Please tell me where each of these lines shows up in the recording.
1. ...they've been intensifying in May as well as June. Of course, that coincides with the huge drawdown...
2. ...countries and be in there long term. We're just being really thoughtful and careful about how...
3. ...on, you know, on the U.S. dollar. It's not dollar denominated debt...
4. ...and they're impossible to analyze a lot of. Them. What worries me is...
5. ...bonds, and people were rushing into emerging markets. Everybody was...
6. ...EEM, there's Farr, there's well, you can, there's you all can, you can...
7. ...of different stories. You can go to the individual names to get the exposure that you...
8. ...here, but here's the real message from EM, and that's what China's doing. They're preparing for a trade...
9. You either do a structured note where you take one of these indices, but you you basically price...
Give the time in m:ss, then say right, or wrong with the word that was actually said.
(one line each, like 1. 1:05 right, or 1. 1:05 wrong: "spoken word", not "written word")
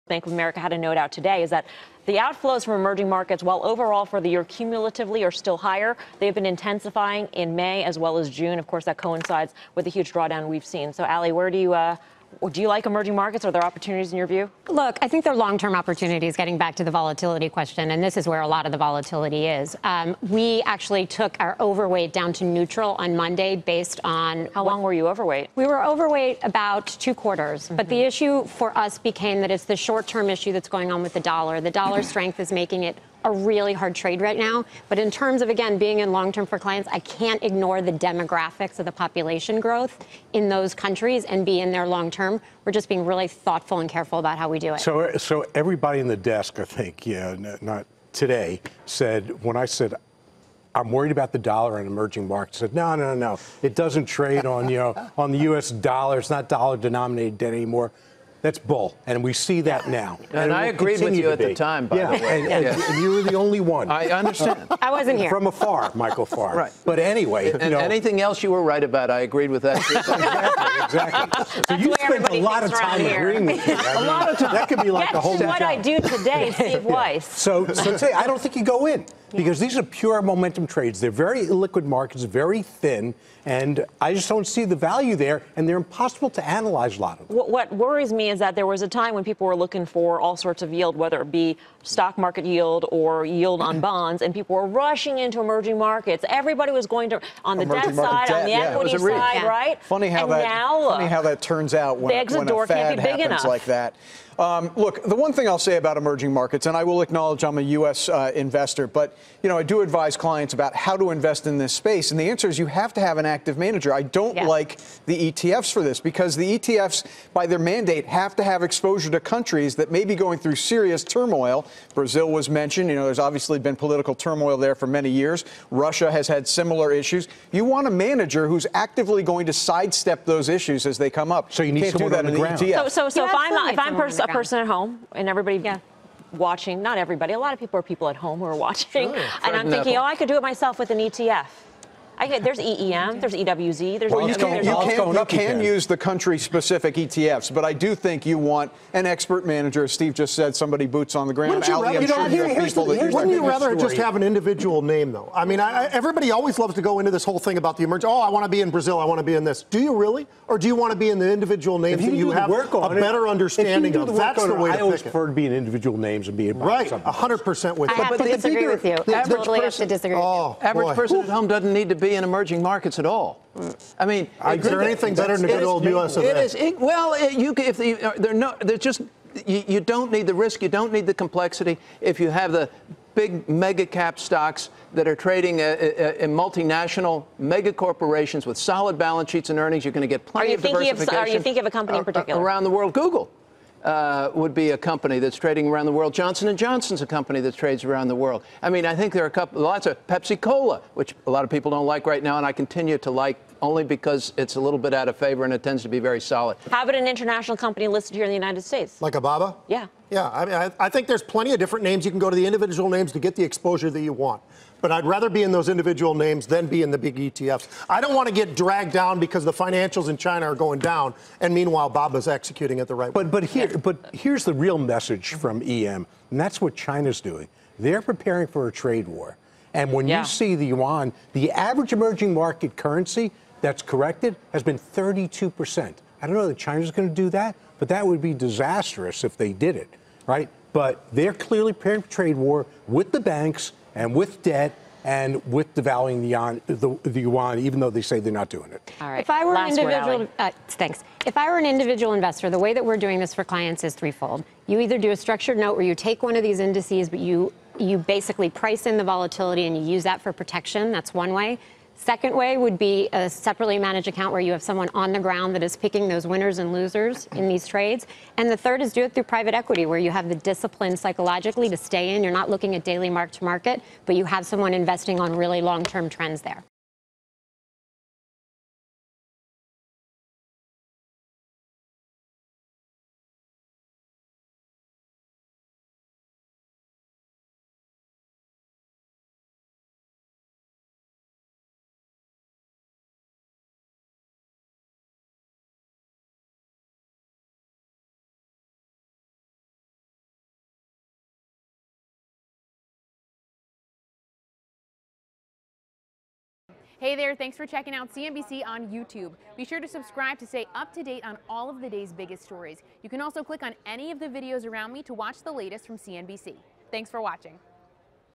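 1. 0:06 right
2. 0:40 right
3. 0:54 right
4. 1:25 right
5. 1:33 right
6. 2:22 wrong: "EWZ", not "Farr"
7. 3:31 wrong: "names", not "stories"
8. 3:43 right
9. 4:14 right.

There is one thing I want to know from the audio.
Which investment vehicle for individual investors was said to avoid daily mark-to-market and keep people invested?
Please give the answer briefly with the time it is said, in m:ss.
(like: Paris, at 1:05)
private equity, at 4:29.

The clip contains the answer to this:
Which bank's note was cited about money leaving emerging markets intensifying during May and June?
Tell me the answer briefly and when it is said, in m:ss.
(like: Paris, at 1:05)
Bank of America, at 0:00.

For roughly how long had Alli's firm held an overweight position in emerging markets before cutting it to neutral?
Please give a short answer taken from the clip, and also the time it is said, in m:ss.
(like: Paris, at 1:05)
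two quarters, at 0:26.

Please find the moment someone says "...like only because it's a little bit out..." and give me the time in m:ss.
3:23.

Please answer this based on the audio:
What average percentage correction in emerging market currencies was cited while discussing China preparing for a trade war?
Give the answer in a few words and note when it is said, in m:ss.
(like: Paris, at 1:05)
32%, at 3:54.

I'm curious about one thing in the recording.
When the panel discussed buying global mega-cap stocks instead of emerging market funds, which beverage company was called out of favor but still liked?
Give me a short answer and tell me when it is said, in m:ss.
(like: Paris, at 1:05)
Pepsi Cola, at 3:20.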